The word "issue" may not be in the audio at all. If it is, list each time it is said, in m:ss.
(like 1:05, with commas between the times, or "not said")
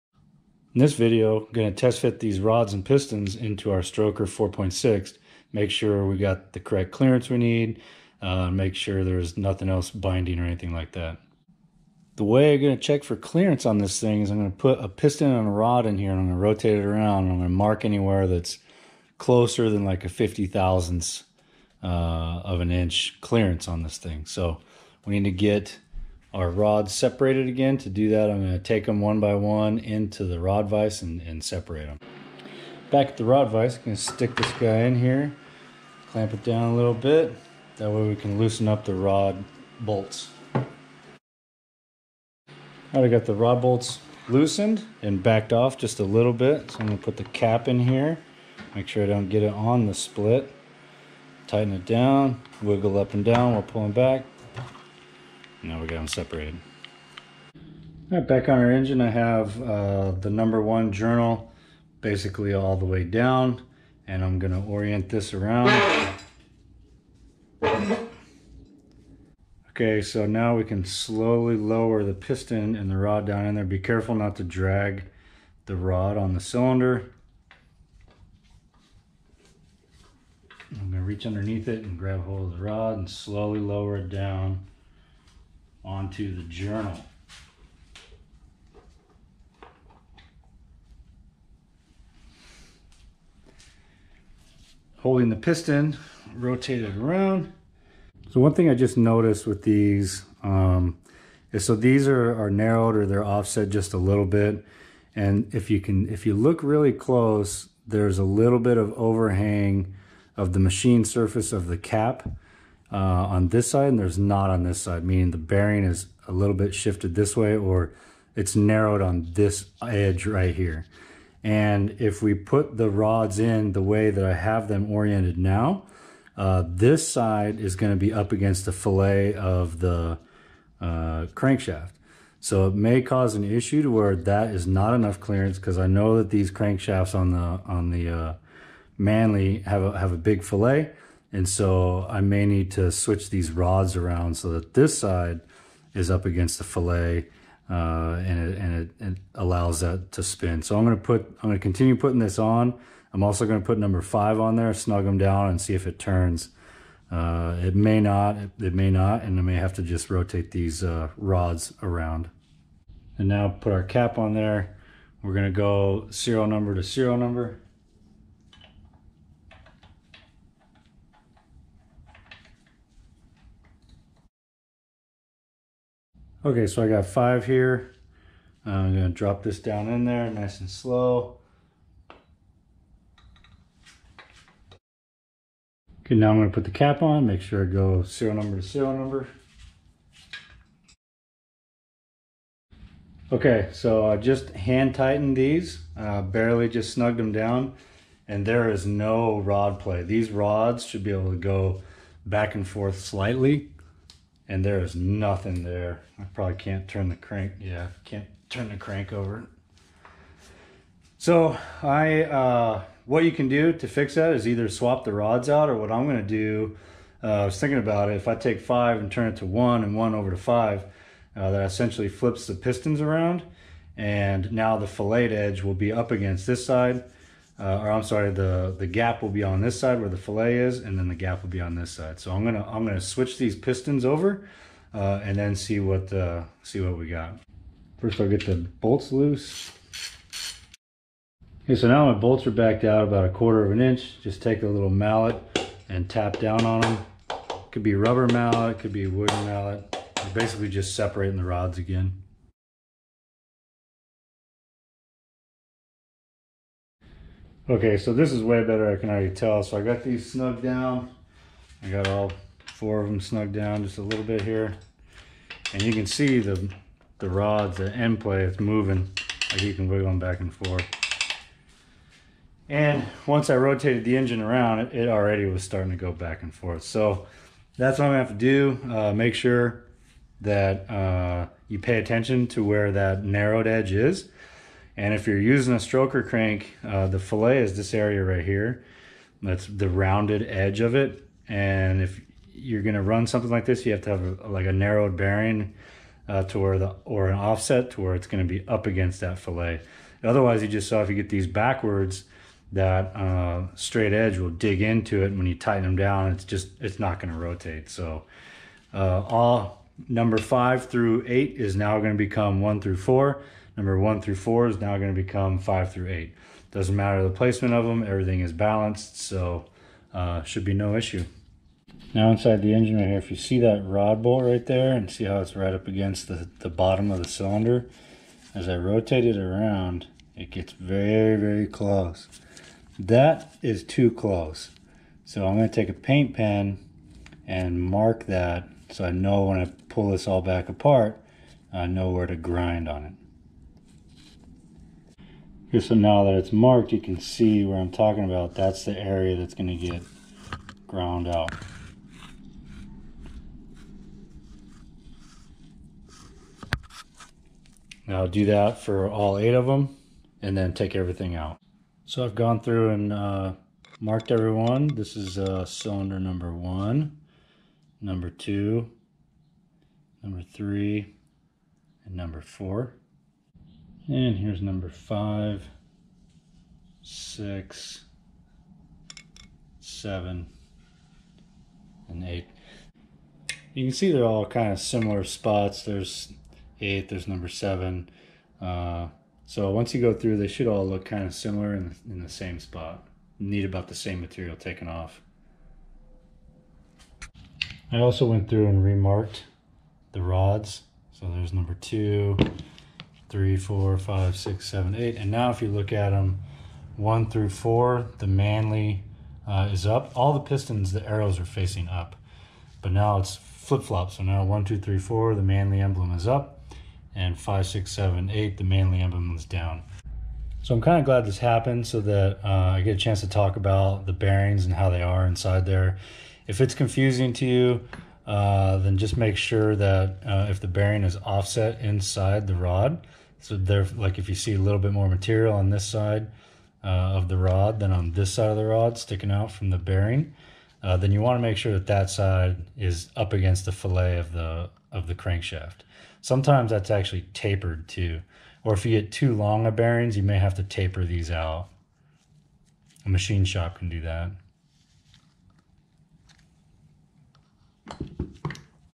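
2:13, 5:20.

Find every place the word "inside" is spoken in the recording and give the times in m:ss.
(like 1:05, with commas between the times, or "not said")
5:22, 7:05, 7:11.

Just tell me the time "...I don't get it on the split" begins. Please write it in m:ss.
0:49.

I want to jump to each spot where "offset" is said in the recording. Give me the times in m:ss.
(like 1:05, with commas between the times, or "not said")
1:43, 4:57, 7:11.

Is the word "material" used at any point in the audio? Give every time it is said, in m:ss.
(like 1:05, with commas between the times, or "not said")
6:34, 7:15.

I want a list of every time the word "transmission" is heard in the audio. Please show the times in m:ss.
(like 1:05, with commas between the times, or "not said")
not said.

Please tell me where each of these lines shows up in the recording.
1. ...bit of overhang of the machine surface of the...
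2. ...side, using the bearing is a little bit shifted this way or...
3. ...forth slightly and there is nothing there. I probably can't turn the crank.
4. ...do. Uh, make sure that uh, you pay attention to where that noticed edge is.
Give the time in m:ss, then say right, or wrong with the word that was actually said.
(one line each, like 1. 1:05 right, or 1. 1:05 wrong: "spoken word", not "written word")
1. 1:48 right
2. 1:54 wrong: "meaning", not "using"
3. 3:22 right
4. 4:38 wrong: "narrowed", not "noticed".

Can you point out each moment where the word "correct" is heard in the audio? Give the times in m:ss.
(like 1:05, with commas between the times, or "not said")
0:06.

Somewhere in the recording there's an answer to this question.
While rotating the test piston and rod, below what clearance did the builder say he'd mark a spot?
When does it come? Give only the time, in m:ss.
0:20.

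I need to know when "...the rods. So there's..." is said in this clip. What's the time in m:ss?
6:40.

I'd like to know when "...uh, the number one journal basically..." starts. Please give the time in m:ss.
0:59.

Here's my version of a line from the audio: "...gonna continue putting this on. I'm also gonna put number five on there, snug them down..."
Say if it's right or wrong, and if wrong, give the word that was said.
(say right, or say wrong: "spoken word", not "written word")
right.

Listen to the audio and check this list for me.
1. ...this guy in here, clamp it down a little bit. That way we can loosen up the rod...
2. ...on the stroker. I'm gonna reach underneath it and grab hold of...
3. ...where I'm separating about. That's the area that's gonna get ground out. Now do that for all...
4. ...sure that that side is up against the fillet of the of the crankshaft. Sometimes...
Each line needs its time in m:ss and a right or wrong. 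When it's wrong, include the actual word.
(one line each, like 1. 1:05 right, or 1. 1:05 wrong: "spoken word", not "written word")
1. 0:34 right
2. 1:16 wrong: "cylinder", not "stroker"
3. 5:47 wrong: "talking", not "separating"
4. 7:21 right.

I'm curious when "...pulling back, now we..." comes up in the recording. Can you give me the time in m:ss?
0:53.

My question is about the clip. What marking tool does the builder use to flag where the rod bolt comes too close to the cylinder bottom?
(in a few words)
paint pen.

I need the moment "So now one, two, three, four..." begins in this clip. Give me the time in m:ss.
6:54.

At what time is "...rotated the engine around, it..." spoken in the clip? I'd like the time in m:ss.
4:33.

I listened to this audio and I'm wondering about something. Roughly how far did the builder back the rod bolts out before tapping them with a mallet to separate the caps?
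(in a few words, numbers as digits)
a quarter of an inch.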